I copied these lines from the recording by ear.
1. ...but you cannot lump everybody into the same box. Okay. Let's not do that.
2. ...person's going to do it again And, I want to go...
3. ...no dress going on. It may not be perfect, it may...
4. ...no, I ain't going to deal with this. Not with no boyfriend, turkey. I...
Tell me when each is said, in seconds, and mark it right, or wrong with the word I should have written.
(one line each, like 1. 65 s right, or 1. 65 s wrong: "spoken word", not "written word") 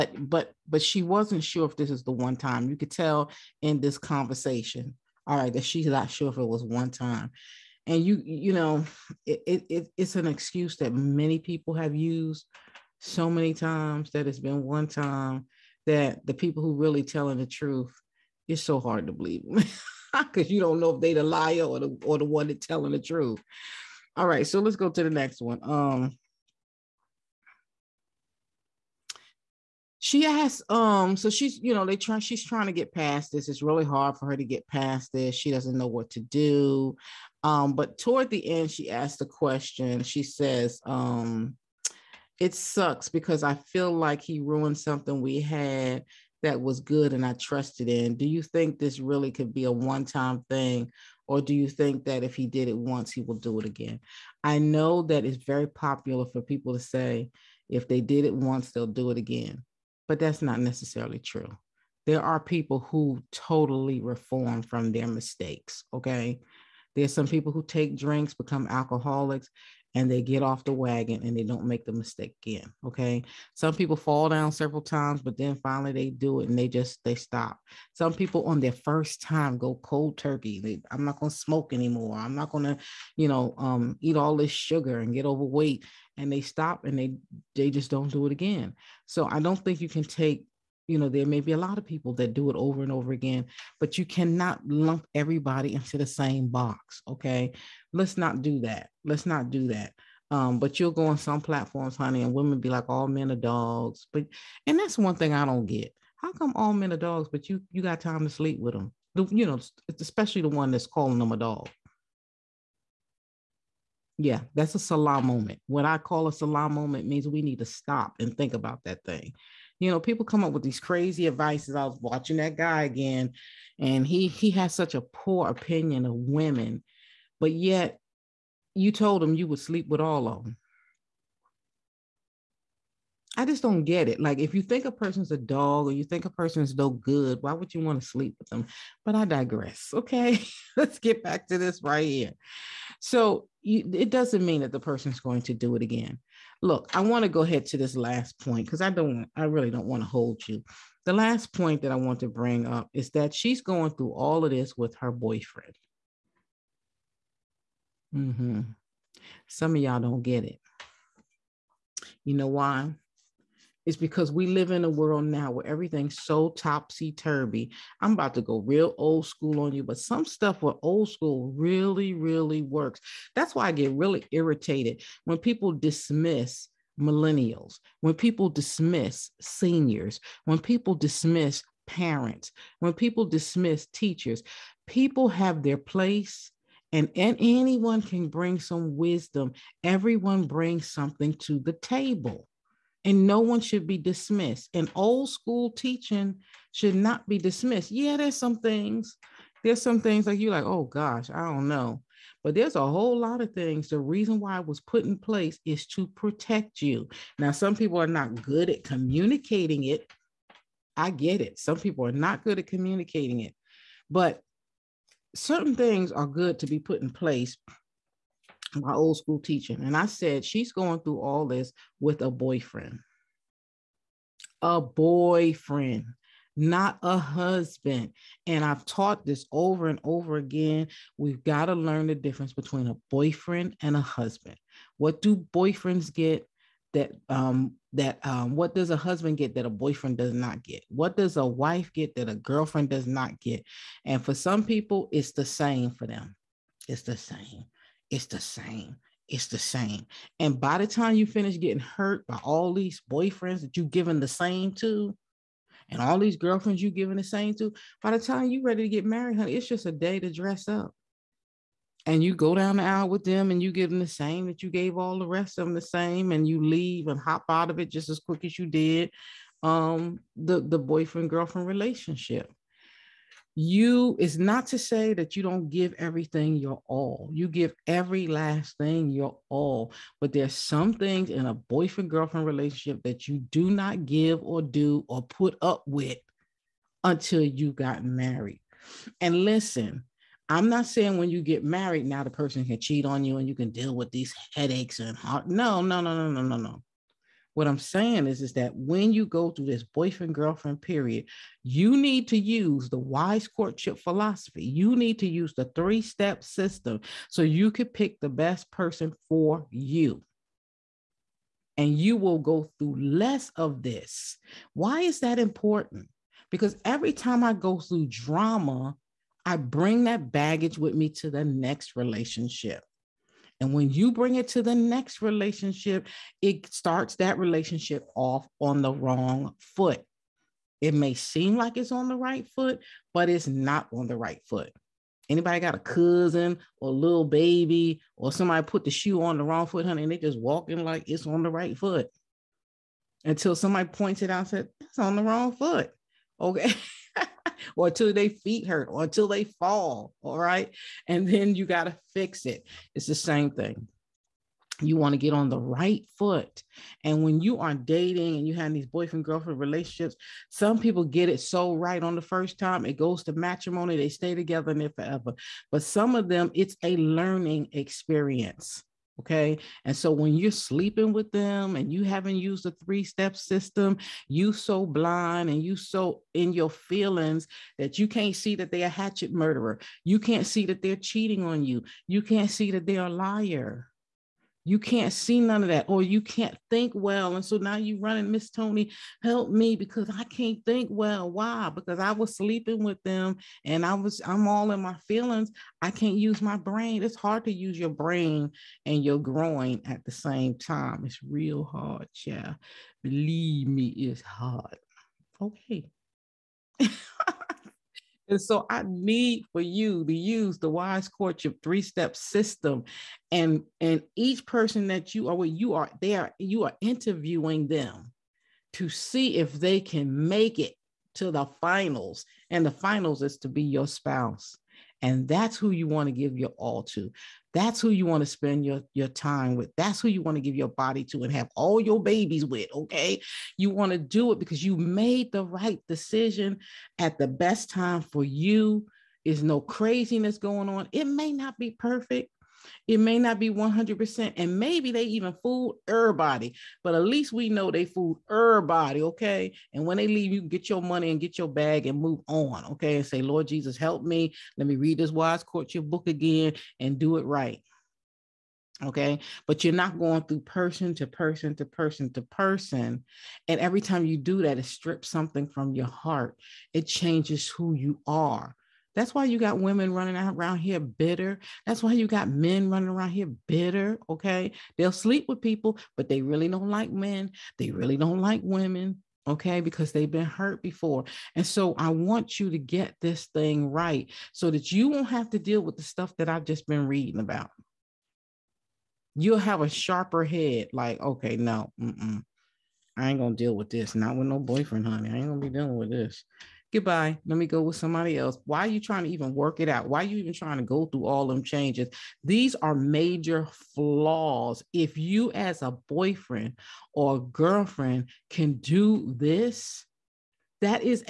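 1. 93 s right
2. 144 s wrong: "Look", not "And"
3. 439 s wrong: "craziness", not "dress"
4. 491 s wrong: "honey", not "turkey".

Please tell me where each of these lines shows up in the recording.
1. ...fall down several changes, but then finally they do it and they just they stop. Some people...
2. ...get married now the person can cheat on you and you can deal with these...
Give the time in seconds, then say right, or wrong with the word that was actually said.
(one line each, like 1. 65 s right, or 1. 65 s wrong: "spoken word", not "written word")
1. 73 s wrong: "times", not "changes"
2. 291 s right.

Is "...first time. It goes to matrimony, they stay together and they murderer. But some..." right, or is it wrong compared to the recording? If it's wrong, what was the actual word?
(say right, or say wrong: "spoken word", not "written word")
wrong: "forever", not "murderer".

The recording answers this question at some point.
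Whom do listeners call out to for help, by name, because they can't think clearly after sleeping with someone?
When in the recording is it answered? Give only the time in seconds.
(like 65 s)
388 s.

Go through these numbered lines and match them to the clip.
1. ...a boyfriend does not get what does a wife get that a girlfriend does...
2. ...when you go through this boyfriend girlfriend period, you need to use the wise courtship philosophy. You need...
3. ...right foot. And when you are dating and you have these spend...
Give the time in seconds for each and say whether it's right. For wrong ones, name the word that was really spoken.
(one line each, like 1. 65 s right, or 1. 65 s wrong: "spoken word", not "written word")
1. 239 s right
2. 298 s right
3. 355 s wrong: "boyfriend", not "spend".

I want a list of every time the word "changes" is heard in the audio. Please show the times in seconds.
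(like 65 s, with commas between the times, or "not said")
466 s, 501 s.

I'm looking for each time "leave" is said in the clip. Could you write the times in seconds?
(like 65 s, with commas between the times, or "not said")
266 s, 450 s.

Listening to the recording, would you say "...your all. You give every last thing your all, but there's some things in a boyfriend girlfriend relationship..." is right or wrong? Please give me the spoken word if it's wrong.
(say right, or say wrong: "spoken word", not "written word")
right.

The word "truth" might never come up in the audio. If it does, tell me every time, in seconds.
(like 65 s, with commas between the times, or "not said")
17 s, 22 s.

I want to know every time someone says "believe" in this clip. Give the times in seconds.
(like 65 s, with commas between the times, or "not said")
19 s, 403 s.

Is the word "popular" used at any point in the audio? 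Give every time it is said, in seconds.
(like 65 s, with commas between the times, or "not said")
55 s.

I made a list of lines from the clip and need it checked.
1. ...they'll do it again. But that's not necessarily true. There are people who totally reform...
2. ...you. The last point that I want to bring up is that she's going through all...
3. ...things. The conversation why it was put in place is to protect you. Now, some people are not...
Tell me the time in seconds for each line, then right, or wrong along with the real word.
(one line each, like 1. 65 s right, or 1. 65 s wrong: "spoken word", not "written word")
1. 58 s right
2. 150 s right
3. 203 s wrong: "reason", not "conversation".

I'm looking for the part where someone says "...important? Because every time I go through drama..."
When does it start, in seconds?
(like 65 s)
315 s.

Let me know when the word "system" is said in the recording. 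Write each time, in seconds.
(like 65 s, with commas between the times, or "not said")
306 s, 373 s, 412 s.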